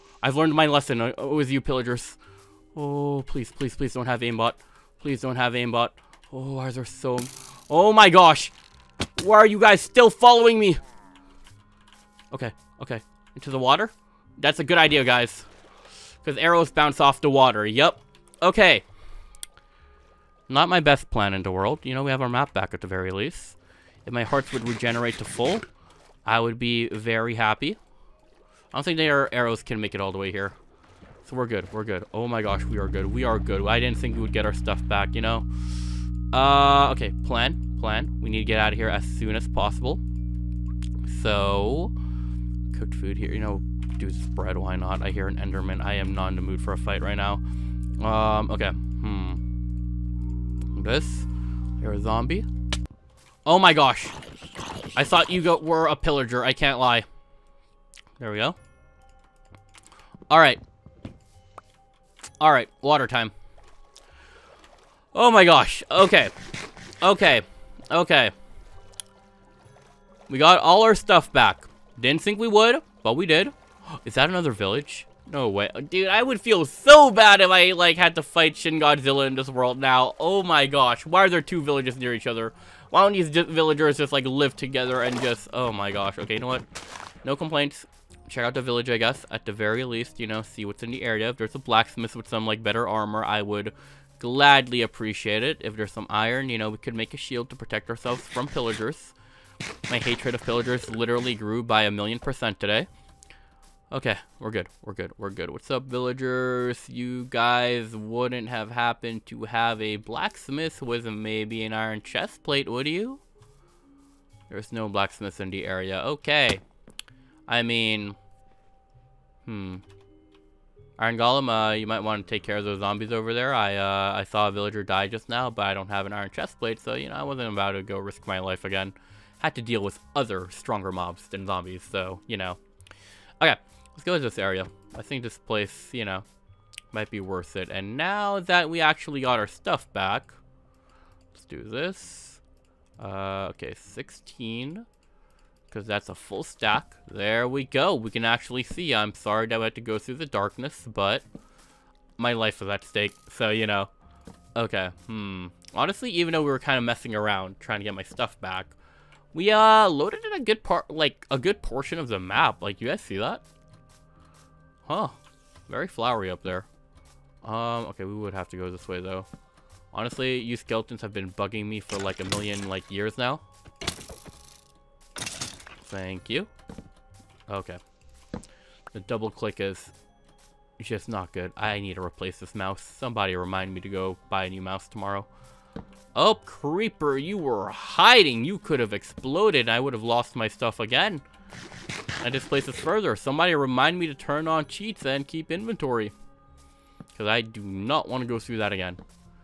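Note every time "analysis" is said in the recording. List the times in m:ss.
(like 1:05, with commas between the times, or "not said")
not said.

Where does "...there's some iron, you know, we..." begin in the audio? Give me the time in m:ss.
1:35.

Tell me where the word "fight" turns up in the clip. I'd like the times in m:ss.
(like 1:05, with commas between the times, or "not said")
0:46, 1:18.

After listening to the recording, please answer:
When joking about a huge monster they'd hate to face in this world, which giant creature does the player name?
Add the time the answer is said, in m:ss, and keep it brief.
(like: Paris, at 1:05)
Shin Godzilla, at 1:18.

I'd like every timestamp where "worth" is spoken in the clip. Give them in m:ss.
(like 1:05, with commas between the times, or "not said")
2:17.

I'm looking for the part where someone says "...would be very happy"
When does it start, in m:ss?
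0:26.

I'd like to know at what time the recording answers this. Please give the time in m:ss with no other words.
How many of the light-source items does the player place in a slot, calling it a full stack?
2:23.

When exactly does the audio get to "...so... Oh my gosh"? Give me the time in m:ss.
0:06.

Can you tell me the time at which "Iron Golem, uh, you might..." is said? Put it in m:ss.
2:00.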